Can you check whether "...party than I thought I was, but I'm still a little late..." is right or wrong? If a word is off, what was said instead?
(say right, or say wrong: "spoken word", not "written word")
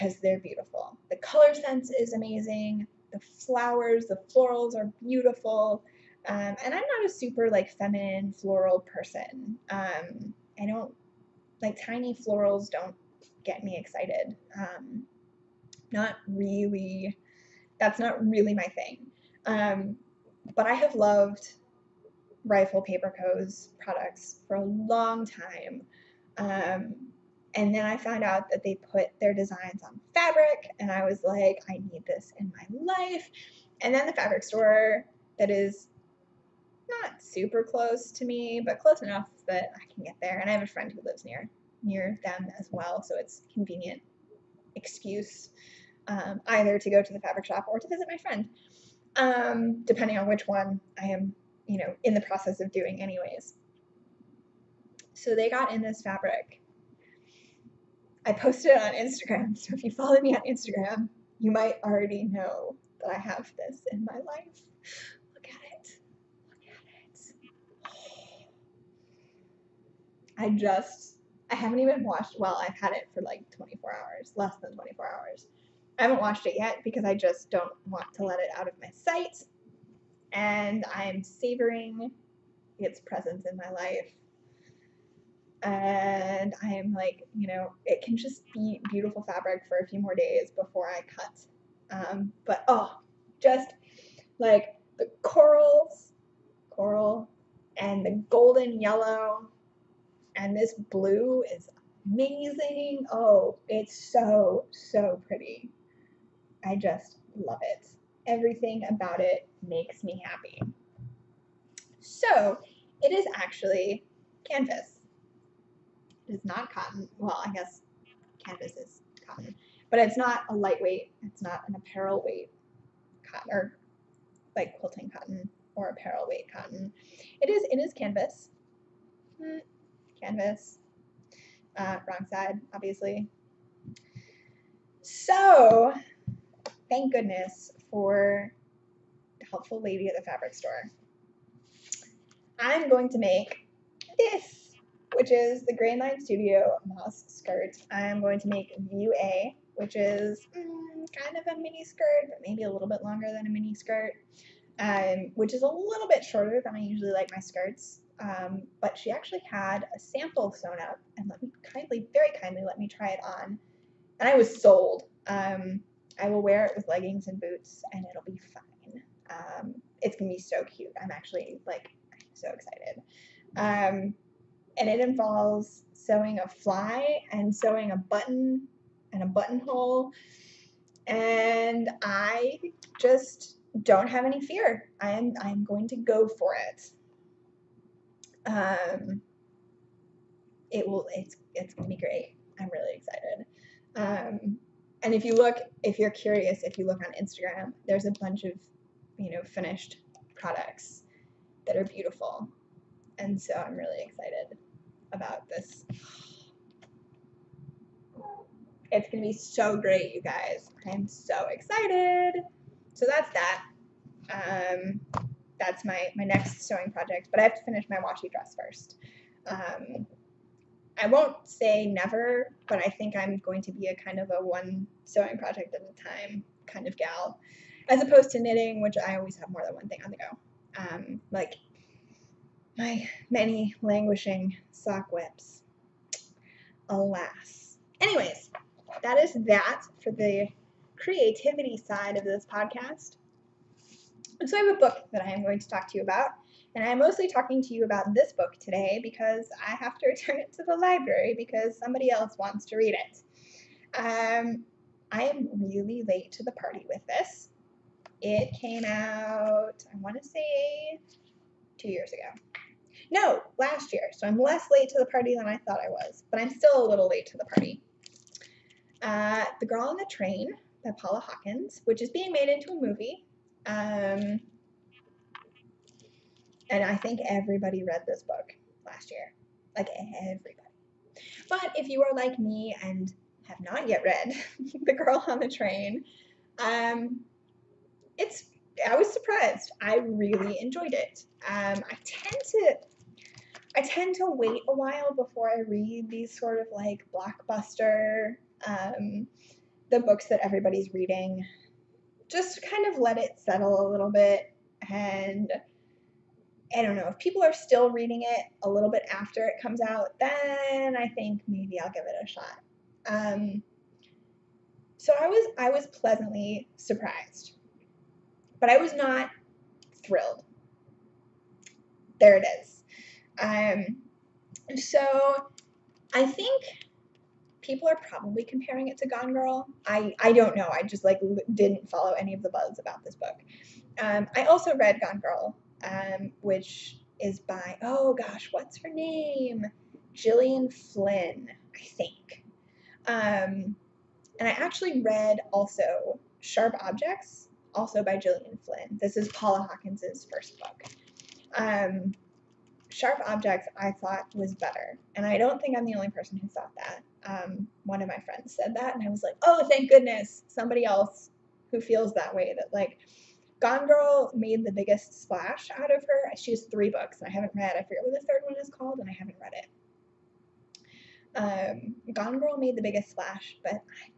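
right.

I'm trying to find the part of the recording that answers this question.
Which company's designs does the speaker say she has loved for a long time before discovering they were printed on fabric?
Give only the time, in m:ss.
0:22.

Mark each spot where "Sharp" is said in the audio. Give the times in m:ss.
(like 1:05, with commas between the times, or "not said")
5:46, 5:52.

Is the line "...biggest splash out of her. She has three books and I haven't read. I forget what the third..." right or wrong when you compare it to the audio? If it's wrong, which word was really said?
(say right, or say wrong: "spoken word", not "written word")
right.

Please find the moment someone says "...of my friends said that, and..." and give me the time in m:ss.
5:58.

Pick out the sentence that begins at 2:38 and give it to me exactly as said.
Um, but she actually had a sample sewn up and let me kindly, very kindly, let me try it on.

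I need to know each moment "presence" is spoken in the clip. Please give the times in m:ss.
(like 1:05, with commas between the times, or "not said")
1:22.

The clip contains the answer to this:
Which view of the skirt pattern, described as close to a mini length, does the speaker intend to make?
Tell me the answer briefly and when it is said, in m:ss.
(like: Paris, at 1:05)
View A, at 2:28.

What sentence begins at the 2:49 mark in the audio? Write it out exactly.
Um, it's gonna be so cute.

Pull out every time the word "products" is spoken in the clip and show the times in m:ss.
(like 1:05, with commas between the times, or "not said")
0:23, 3:20.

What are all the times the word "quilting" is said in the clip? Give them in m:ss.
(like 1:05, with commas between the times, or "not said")
2:04.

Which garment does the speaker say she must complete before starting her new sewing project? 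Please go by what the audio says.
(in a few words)
Washi dress.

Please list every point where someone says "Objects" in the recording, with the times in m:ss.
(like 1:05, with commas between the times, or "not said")
5:46, 5:53.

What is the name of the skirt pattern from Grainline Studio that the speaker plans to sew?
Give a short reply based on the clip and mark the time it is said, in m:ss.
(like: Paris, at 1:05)
Moss skirt, at 2:26.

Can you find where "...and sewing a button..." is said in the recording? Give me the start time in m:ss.
2:57.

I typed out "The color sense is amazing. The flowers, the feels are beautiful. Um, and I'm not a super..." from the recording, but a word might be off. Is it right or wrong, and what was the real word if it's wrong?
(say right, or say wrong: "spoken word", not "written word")
wrong: "florals", not "feels".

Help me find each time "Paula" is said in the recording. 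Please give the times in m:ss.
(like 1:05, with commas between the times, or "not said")
4:30, 5:49.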